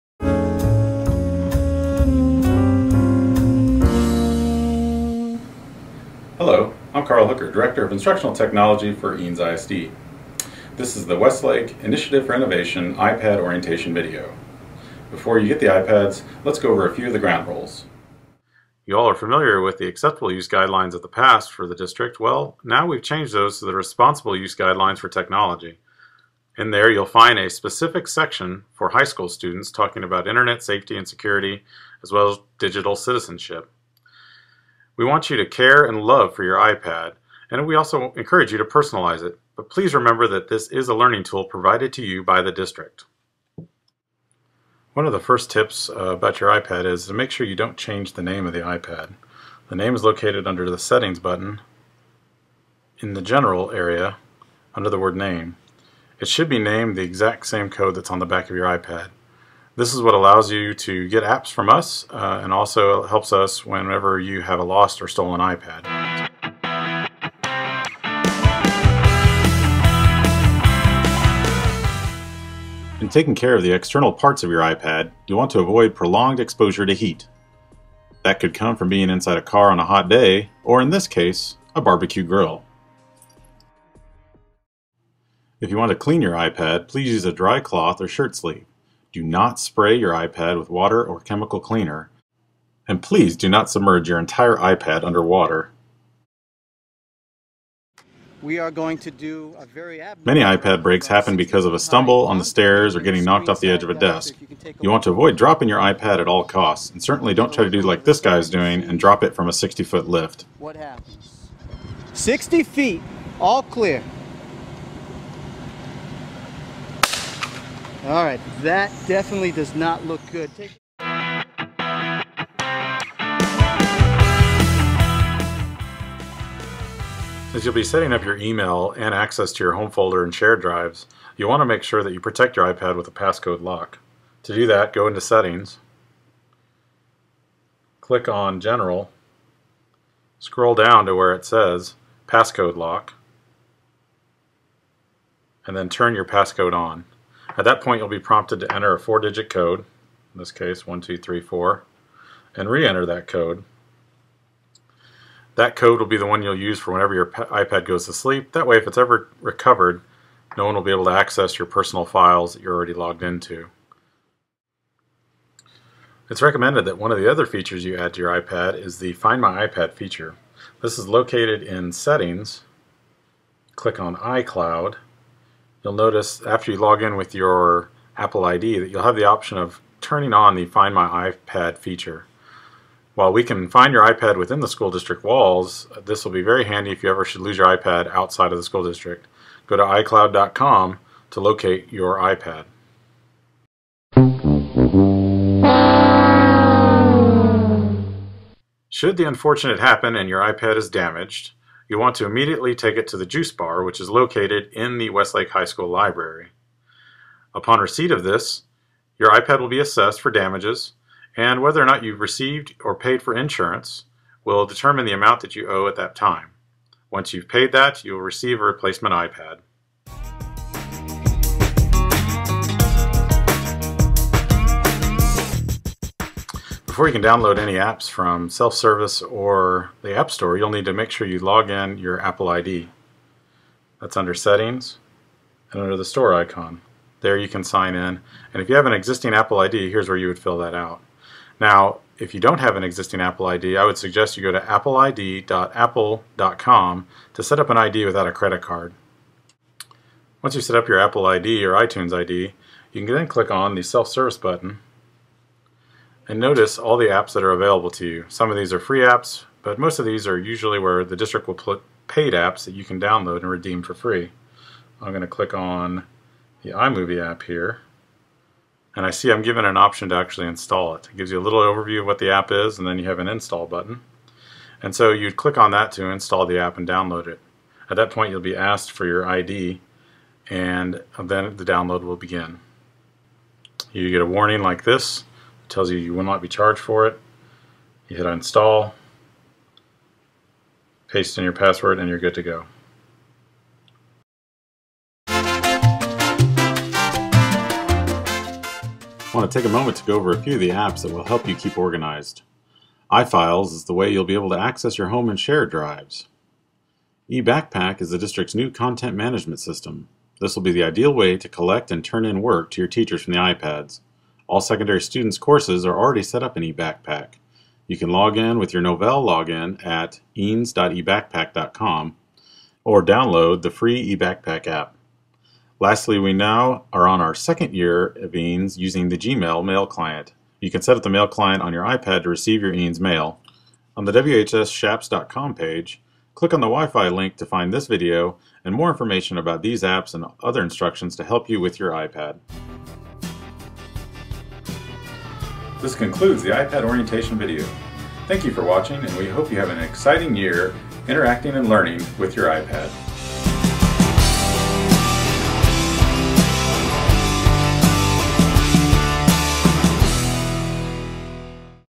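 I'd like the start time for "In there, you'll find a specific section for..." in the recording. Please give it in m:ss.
0:26.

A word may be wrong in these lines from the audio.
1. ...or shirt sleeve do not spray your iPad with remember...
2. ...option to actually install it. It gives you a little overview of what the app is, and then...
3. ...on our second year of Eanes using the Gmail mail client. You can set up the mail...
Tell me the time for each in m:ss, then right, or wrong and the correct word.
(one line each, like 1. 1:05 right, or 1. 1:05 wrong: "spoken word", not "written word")
1. 1:28 wrong: "water", not "remember"
2. 4:29 right
3. 5:27 right.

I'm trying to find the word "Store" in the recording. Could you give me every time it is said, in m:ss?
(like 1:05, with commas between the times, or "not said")
3:50, 3:56.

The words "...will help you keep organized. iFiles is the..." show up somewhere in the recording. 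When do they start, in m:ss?
5:01.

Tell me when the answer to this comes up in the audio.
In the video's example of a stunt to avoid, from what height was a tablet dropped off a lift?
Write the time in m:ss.
1:49.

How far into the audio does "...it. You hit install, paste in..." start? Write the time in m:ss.
4:47.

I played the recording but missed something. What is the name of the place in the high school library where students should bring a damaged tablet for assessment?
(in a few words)
juice bar.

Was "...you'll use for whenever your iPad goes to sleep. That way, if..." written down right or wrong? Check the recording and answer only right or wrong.
right.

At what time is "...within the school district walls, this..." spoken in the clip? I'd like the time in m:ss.
3:04.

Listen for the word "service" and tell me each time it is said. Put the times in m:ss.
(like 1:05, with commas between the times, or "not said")
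3:48, 4:13.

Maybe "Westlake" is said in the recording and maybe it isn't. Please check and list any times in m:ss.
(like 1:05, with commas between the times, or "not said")
0:11, 3:25.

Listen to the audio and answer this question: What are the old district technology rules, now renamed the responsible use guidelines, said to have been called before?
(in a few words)
acceptable use guidelines.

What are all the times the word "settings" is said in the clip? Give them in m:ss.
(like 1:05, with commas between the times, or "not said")
0:50, 2:07, 2:15, 2:51, 3:54.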